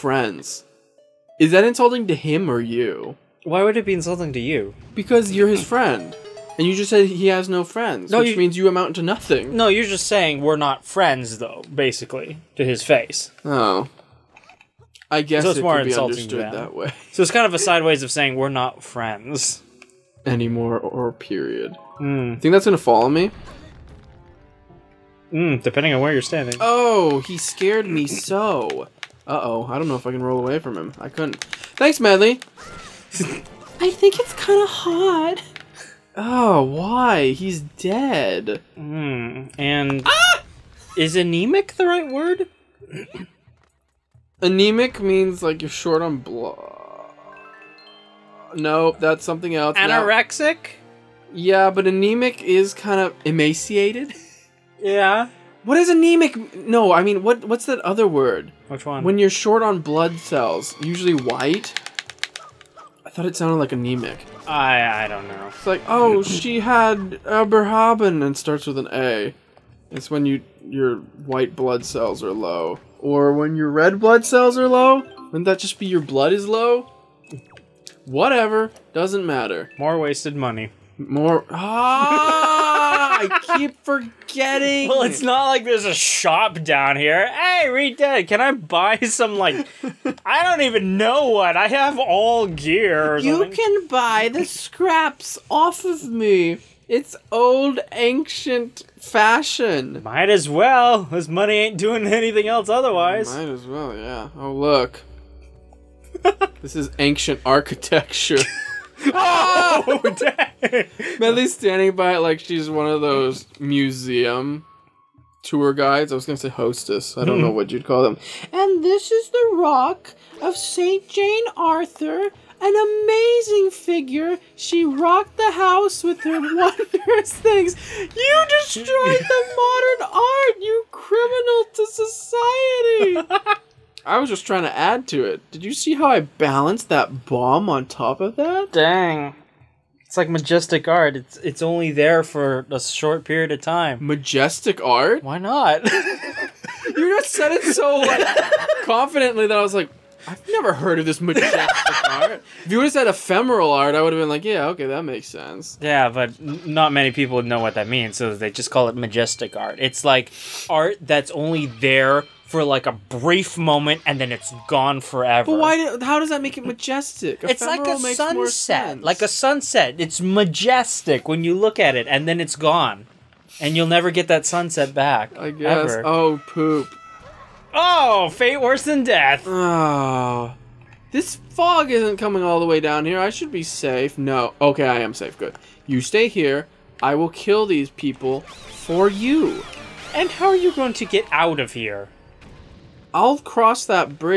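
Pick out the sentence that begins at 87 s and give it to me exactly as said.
Hey, Redid, can I buy some like?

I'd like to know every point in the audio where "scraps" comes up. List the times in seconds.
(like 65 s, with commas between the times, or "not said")
94 s.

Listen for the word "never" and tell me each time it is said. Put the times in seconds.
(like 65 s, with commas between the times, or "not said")
150 s, 173 s.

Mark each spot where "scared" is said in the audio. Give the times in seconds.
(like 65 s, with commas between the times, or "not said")
27 s.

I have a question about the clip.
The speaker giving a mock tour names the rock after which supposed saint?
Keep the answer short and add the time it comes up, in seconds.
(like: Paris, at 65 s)
Saint Jane Arthur, at 120 s.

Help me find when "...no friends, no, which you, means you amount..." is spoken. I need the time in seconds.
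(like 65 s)
7 s.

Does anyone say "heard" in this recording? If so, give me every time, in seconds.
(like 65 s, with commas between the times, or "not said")
150 s.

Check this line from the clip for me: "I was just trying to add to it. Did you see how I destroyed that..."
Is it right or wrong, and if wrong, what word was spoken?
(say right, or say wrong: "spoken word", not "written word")
wrong: "balanced", not "destroyed".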